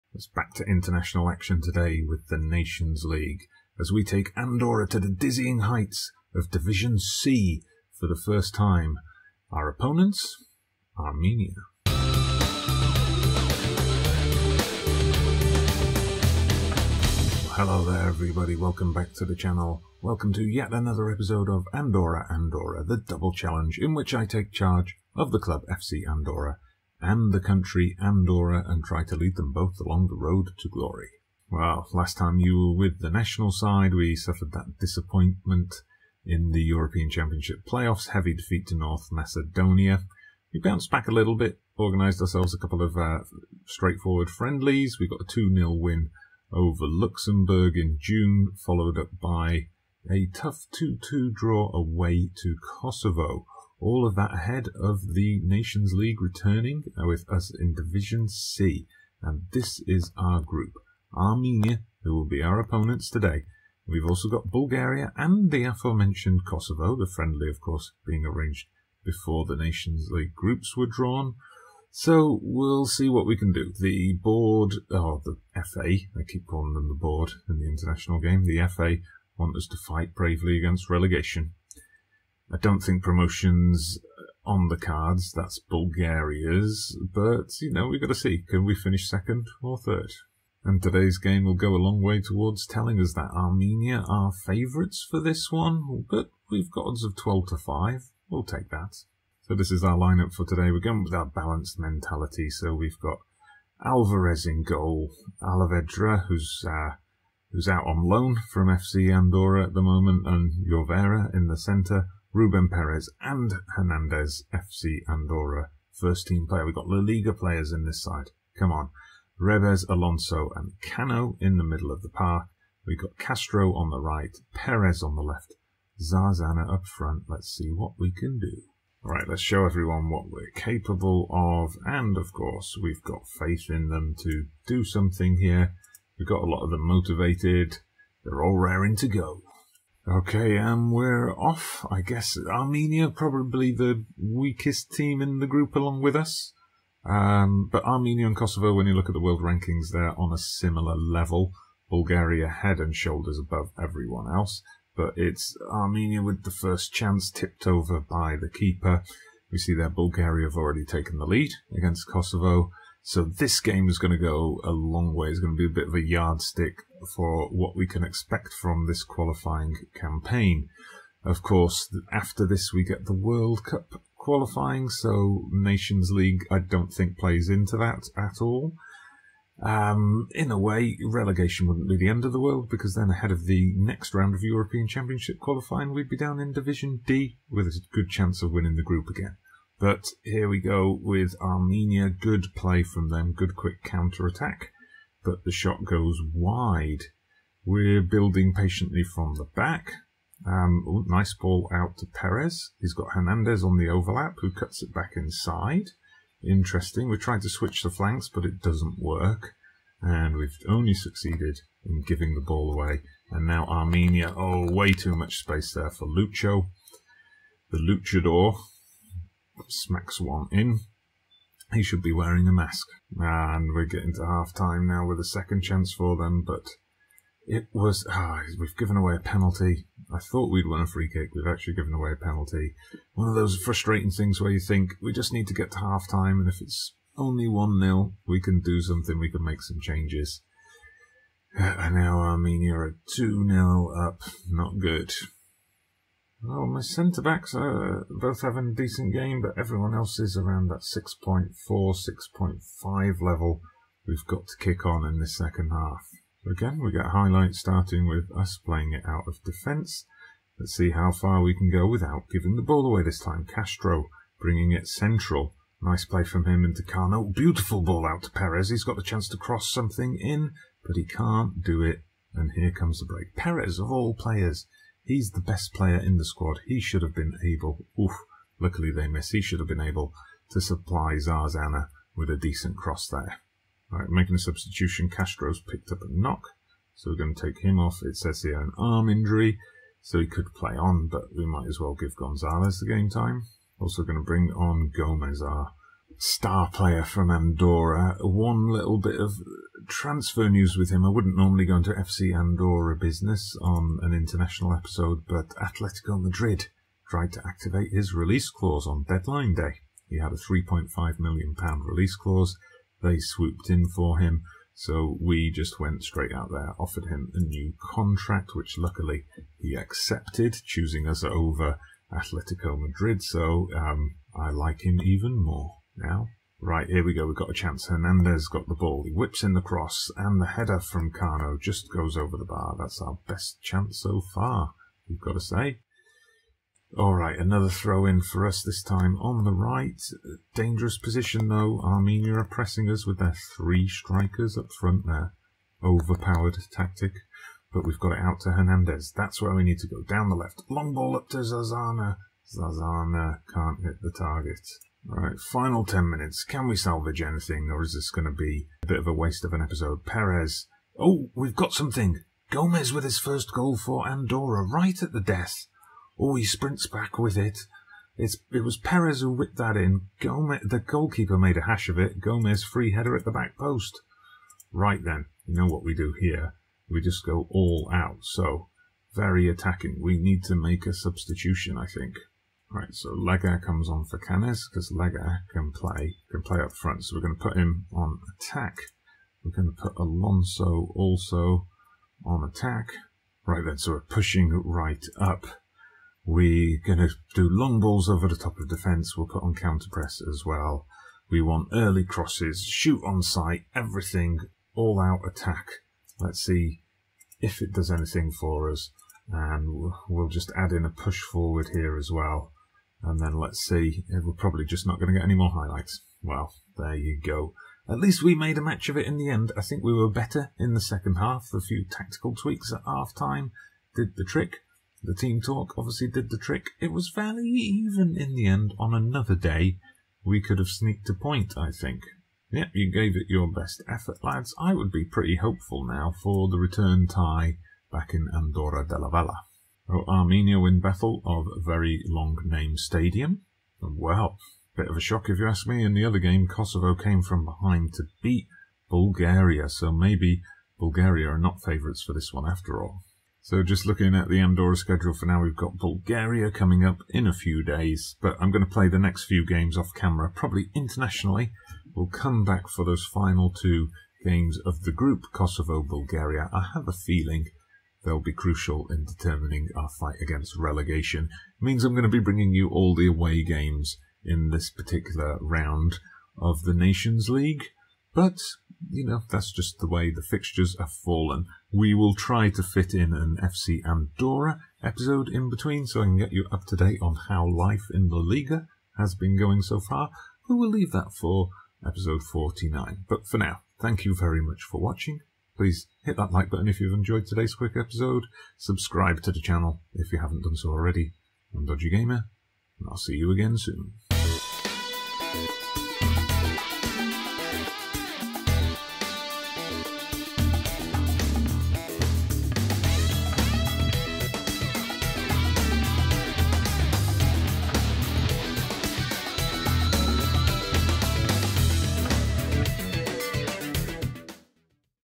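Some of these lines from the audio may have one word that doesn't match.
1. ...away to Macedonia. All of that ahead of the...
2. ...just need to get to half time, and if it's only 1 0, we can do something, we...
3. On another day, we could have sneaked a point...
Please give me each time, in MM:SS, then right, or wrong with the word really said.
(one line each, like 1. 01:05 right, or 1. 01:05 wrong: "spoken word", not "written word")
1. 00:51 wrong: "Kosovo", not "Macedonia"
2. 03:55 right
3. 07:08 right.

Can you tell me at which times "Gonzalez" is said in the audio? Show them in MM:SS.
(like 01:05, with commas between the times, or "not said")
04:52.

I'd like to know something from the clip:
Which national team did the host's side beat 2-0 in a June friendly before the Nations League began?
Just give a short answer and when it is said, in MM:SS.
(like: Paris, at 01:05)
Luxembourg, at 00:46.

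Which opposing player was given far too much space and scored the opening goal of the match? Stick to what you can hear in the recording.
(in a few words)
Lucho.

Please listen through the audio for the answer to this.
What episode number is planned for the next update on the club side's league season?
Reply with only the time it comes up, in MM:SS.
08:12.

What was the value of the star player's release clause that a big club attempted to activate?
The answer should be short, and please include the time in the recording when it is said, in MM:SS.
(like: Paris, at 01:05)
£3.5 million, at 05:10.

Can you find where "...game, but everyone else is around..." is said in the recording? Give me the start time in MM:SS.
04:09.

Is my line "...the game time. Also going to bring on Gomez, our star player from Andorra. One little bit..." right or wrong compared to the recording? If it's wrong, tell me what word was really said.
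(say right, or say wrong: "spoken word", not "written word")
right.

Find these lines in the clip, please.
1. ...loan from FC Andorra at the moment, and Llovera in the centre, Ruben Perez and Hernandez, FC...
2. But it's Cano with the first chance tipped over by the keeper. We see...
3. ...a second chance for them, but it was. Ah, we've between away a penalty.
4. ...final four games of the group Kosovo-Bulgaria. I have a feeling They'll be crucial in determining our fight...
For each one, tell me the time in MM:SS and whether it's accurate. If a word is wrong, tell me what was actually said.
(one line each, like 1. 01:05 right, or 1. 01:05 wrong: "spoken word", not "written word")
1. 01:48 right
2. 02:34 wrong: "Armenia", not "Cano"
3. 03:45 wrong: "given", not "between"
4. 07:43 wrong: "two", not "four".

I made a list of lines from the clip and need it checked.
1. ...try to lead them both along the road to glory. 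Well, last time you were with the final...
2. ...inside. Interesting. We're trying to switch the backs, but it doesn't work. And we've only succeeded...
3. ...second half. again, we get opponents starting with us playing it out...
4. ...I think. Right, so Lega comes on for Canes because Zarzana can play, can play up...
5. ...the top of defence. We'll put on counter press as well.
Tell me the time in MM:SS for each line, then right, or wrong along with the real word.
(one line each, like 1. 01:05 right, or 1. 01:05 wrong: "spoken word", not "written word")
1. 00:28 wrong: "national", not "final"
2. 03:25 wrong: "flanks", not "backs"
3. 04:15 wrong: "highlights", not "opponents"
4. 06:21 wrong: "Lega", not "Zarzana"
5. 06:38 right.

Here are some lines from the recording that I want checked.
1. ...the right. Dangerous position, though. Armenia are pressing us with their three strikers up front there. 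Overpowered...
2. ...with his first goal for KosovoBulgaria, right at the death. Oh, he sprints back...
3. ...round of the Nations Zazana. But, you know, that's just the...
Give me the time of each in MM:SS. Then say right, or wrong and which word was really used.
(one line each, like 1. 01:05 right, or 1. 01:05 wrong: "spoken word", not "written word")
1. 05:39 right
2. 06:02 wrong: "Andorra", not "KosovoBulgaria"
3. 07:55 wrong: "League", not "Zazana".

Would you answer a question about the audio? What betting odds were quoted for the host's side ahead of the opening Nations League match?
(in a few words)
12 to 5.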